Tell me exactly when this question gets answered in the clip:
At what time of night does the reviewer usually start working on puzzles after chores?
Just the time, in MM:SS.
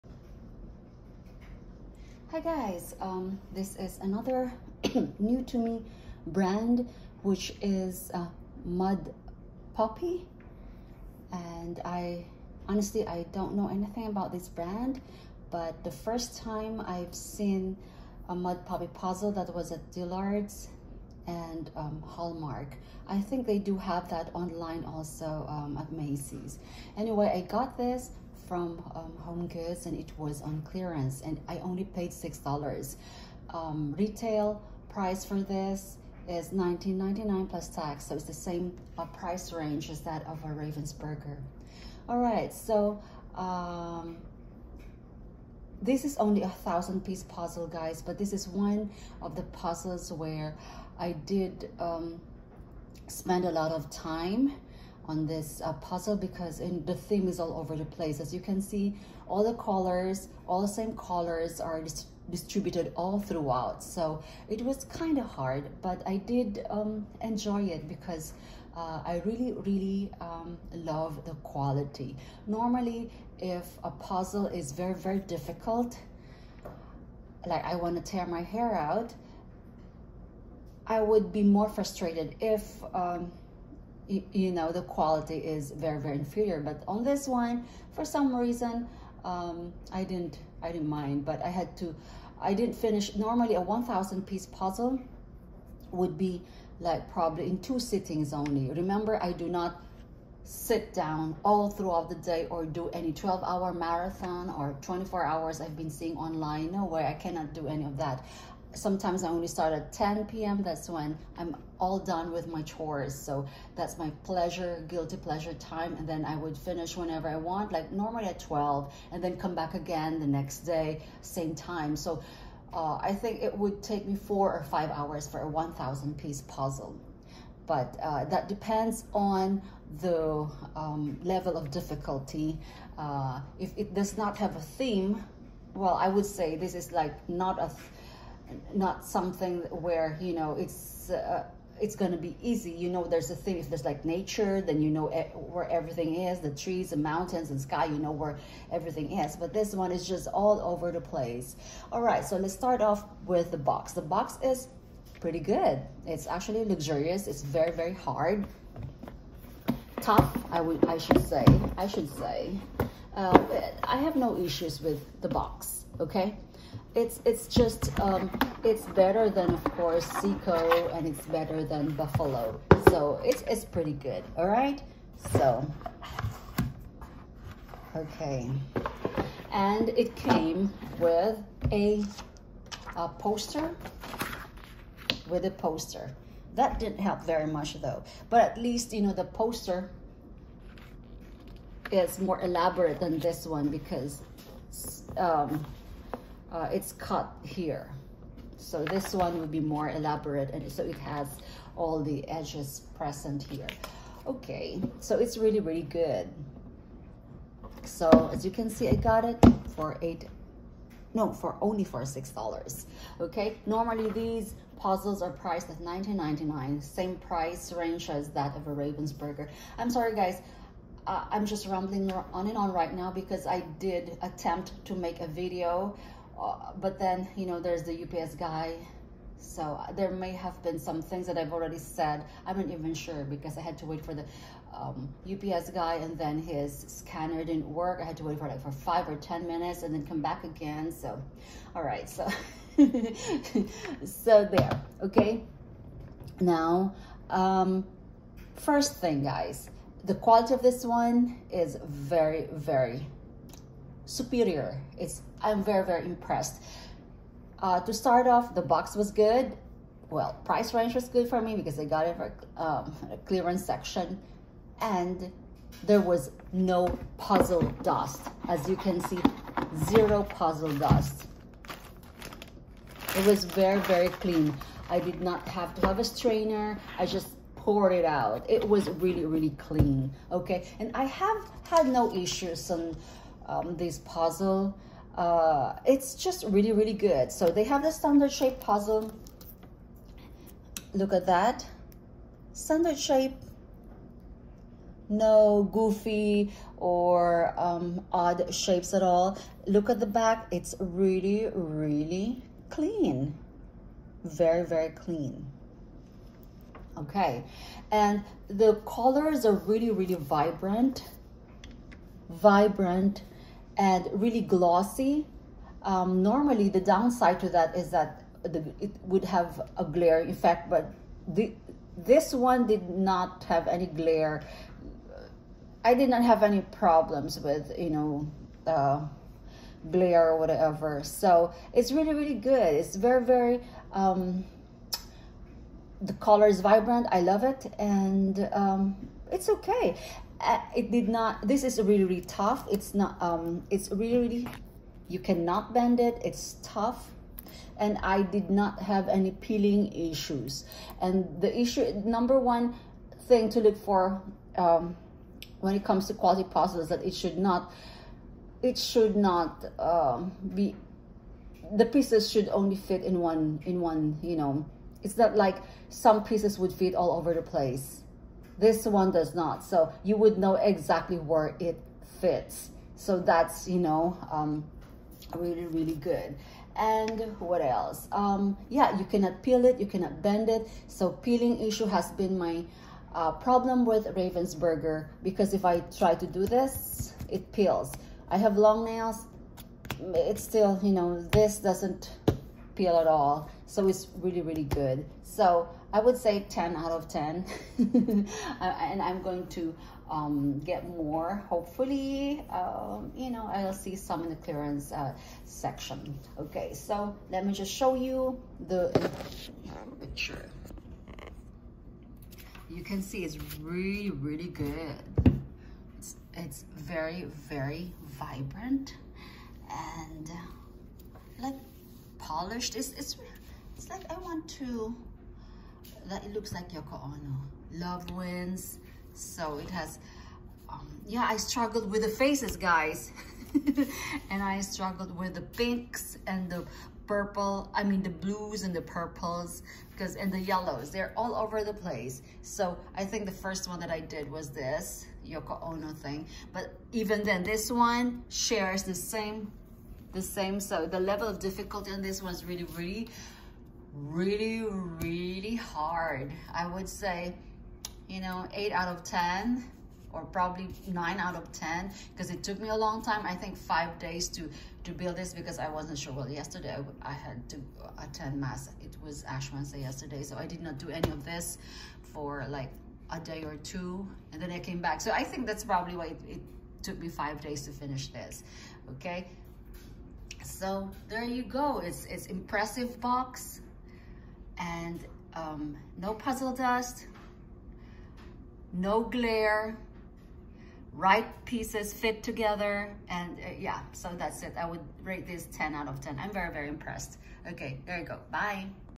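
01:49.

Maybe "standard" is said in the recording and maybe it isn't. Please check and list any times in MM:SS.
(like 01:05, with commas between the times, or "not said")
04:47, 04:52.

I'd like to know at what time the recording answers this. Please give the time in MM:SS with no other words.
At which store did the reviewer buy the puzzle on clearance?
00:29.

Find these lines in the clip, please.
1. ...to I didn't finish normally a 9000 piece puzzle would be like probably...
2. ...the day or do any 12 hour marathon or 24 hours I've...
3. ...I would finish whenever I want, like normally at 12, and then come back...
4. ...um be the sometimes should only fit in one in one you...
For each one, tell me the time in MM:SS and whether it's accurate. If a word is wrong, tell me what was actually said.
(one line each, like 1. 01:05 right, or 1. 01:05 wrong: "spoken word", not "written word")
1. 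01:31 wrong: "1000", not "9000"
2. 01:42 right
3. 01:56 right
4. 05:59 wrong: "pieces", not "sometimes".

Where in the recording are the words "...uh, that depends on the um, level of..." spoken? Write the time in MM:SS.
02:08.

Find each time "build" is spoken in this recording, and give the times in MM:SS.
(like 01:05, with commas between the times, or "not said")
07:44.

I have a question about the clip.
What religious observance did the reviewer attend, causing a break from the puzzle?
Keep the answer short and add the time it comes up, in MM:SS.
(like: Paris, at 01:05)
Ash Wednesday, at 07:49.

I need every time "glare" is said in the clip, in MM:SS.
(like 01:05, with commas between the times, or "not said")
05:19, 05:23, 05:29, 08:09.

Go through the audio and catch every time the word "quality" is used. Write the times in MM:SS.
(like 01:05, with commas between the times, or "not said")
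01:11, 01:24, 04:10, 05:56.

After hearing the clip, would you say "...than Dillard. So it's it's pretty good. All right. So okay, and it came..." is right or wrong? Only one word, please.
wrong.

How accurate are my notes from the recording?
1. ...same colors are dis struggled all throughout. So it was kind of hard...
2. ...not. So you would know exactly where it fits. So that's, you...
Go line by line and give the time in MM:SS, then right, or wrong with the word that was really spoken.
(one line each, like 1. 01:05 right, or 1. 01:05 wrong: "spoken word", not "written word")
1. 01:00 wrong: "distributed", not "struggled"
2. 06:09 right.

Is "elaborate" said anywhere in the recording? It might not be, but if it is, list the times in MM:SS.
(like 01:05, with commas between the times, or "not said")
03:12, 03:19.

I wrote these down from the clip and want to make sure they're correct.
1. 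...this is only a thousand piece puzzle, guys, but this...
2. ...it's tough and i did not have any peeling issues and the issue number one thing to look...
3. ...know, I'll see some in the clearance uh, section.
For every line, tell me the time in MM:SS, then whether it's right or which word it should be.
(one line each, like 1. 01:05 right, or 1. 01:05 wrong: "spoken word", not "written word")
1. 00:45 right
2. 05:46 right
3. 06:43 right.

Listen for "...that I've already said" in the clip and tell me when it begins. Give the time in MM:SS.
03:51.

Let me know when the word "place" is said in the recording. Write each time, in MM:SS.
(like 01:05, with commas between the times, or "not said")
00:57, 02:31, 06:07, 07:21.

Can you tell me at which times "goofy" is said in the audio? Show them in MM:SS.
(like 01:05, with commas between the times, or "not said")
04:55.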